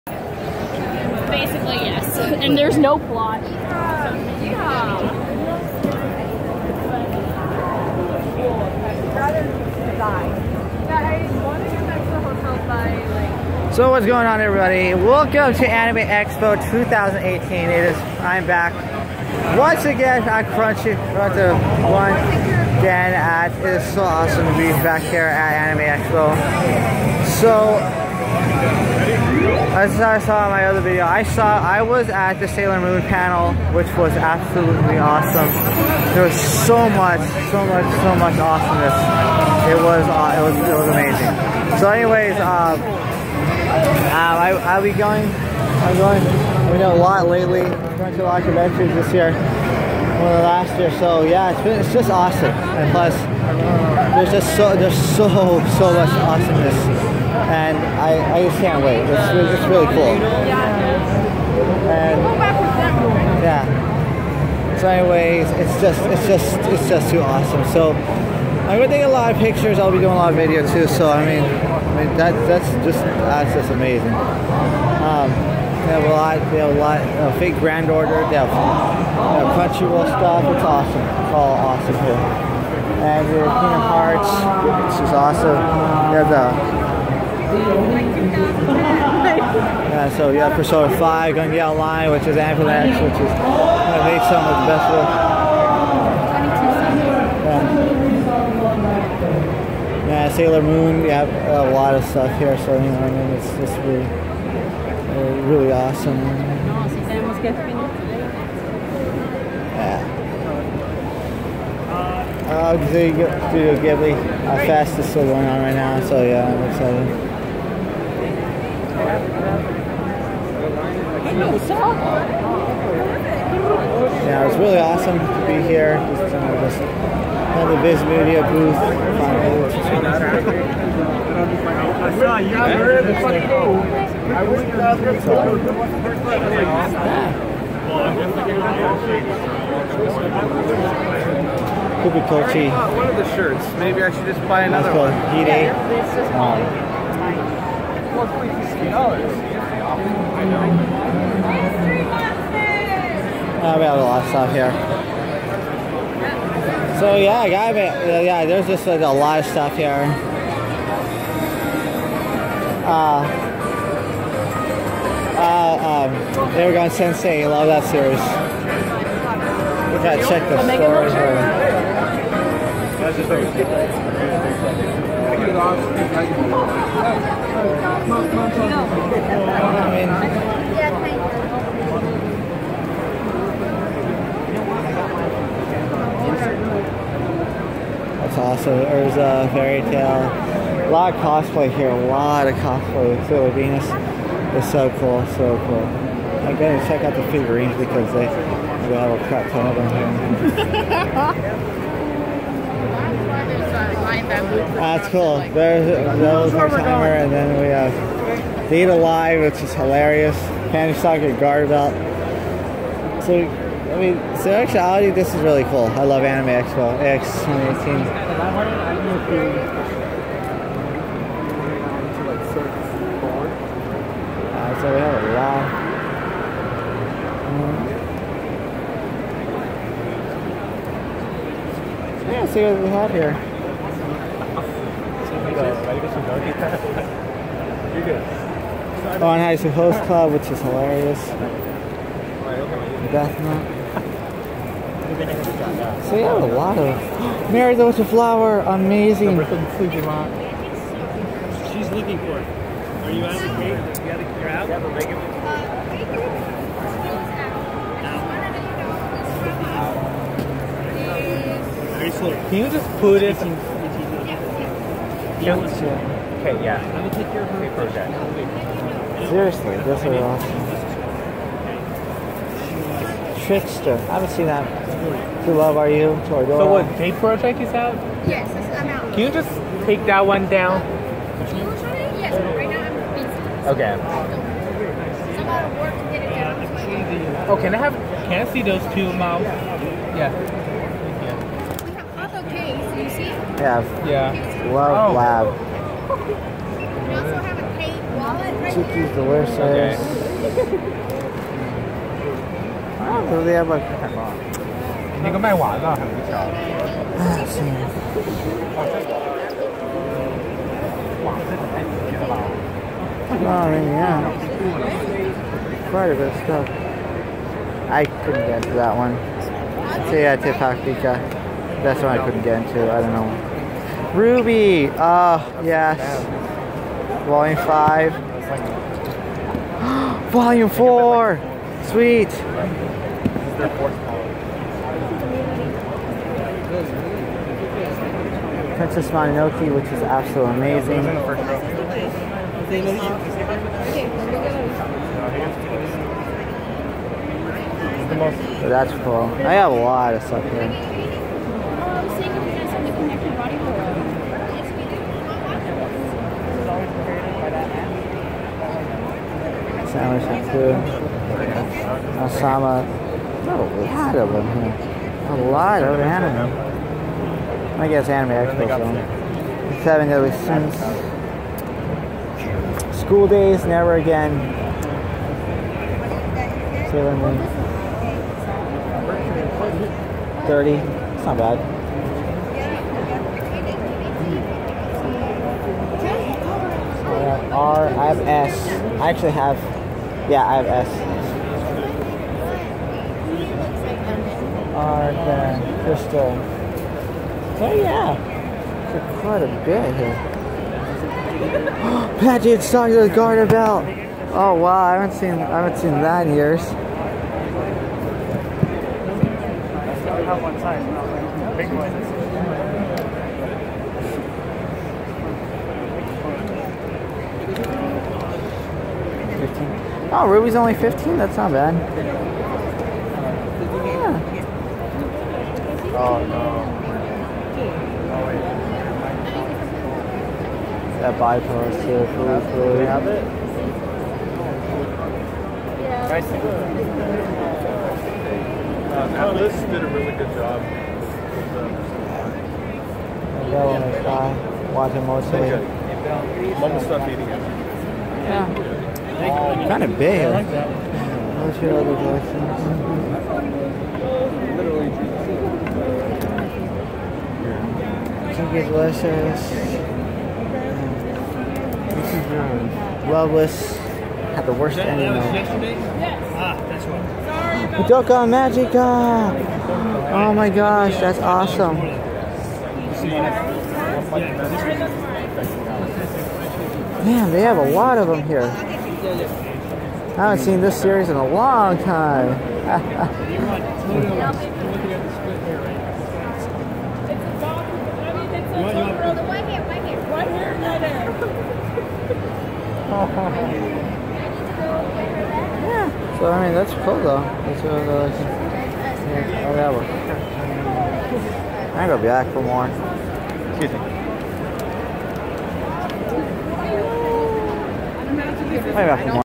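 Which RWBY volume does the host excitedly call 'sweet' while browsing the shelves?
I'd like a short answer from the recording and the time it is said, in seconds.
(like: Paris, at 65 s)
Volume 4, at 330 s.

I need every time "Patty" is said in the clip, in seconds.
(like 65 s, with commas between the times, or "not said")
402 s.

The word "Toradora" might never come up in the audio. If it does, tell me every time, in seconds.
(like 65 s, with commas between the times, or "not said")
276 s.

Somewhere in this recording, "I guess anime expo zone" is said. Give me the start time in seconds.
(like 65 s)
367 s.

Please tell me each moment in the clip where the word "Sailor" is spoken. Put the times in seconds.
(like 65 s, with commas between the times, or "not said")
32 s, 100 s, 193 s, 376 s.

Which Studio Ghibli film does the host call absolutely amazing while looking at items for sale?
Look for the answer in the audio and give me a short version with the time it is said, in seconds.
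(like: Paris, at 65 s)
Princess Mononoke, at 338 s.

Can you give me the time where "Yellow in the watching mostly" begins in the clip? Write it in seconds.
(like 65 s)
443 s.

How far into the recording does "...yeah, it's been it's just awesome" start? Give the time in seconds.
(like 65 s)
51 s.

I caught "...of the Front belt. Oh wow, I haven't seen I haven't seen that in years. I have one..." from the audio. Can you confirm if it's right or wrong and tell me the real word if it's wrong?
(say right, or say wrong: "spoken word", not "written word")
wrong: "Garden", not "Front".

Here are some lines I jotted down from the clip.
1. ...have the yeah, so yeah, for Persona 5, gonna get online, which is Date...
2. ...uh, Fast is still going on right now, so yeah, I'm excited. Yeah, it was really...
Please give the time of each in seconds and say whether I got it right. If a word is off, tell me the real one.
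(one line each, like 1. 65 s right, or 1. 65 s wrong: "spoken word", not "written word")
1. 86 s wrong: "Avalanche", not "Date"
2. 114 s right.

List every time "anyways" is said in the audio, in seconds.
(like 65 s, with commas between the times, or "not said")
41 s, 64 s.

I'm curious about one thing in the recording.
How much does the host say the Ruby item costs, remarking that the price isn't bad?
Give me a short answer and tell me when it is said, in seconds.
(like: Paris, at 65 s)
15, at 420 s.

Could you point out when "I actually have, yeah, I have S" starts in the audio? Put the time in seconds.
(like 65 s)
389 s.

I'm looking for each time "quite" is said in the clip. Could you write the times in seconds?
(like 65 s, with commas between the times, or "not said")
315 s, 399 s.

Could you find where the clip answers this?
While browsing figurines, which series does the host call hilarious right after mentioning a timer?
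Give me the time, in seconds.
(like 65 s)
208 s.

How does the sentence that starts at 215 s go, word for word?
I love Anime Expo AX 2018.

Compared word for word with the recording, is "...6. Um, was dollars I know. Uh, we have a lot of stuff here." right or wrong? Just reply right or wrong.
wrong.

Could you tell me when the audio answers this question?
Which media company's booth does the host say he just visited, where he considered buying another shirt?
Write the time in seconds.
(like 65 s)
127 s.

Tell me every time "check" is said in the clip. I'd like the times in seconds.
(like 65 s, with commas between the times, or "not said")
170 s, 196 s.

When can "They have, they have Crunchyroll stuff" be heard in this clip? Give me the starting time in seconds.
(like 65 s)
78 s.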